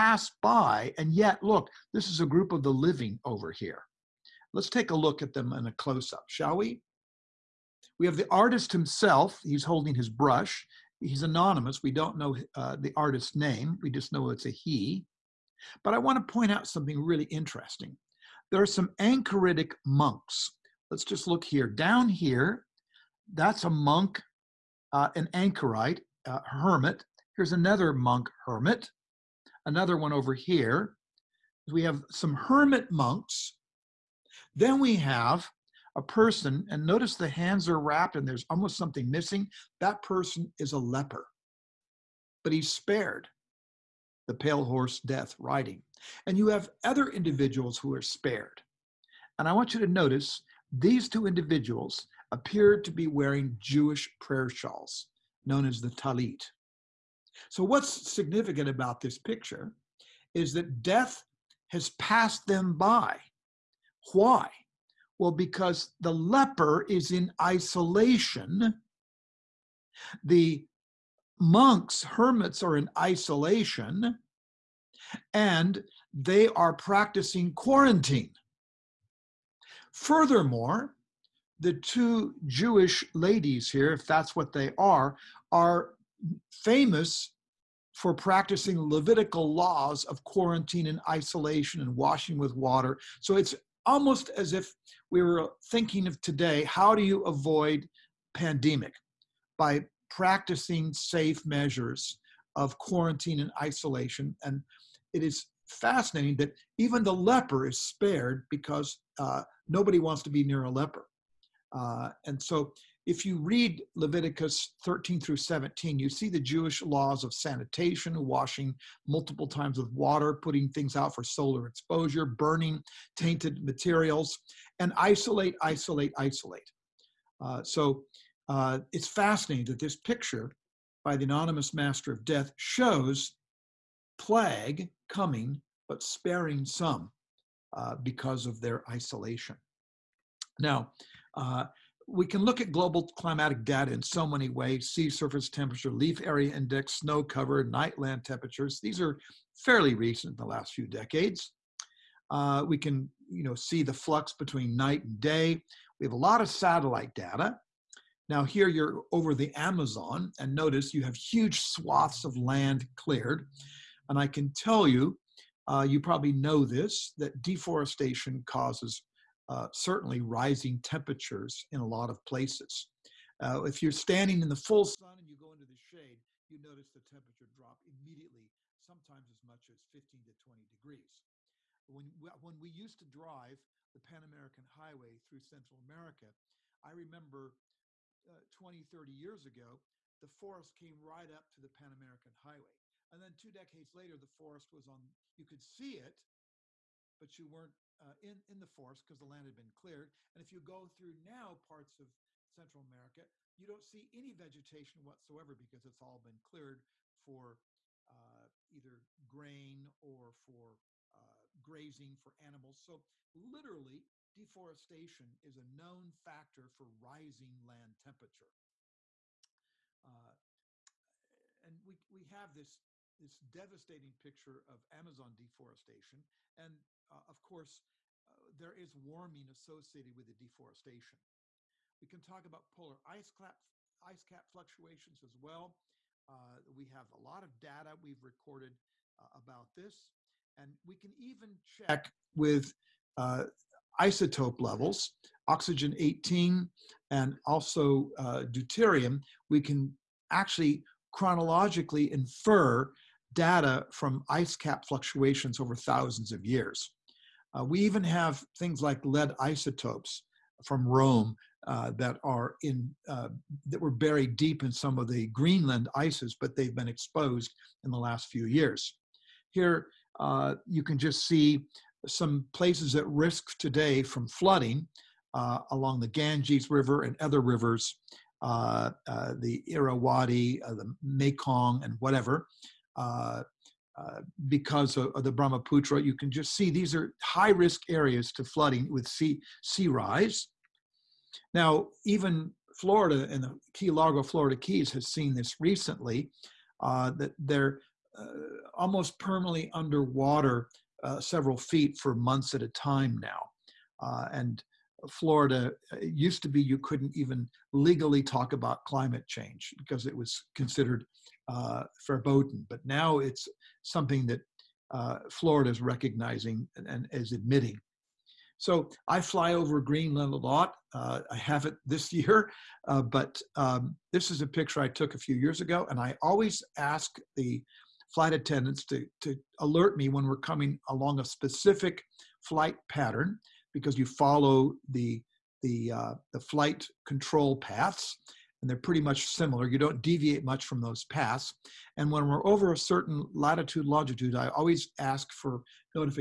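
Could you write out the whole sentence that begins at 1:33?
So it's almost as if we were thinking of today how do you avoid pandemic?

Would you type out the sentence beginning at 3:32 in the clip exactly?
So literally, deforestation is a known factor for rising land temperature.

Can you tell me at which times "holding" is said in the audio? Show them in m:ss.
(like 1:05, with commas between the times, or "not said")
0:09.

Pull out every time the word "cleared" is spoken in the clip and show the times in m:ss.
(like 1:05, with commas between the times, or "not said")
2:42, 3:19, 3:26.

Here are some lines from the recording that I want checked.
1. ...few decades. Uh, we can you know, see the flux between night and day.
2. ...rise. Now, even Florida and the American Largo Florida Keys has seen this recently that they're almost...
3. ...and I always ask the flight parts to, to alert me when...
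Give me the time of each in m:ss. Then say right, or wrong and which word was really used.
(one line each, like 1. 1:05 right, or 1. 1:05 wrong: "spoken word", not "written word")
1. 2:30 right
2. 4:49 wrong: "Key", not "American"
3. 5:25 wrong: "attendants", not "parts".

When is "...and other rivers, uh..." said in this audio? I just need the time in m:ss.
4:37.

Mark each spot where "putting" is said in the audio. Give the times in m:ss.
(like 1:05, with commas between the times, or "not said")
2:00.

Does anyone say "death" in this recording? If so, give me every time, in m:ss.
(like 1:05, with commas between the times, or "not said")
0:44, 1:00, 2:12.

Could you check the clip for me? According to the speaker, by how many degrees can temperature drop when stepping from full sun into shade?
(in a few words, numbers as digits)
15 to 20 degrees.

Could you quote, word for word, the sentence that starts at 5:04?
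Uh, and Florida uh, used to be you couldn't even legally talk about climate change because it was considered uh, verboten.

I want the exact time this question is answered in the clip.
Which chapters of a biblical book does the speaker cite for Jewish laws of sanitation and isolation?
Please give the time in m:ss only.
1:53.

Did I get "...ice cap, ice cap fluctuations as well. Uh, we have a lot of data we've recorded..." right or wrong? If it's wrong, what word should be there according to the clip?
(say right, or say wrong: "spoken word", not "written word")
right.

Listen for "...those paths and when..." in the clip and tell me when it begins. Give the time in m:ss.
5:40.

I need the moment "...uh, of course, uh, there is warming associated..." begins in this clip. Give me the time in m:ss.
3:47.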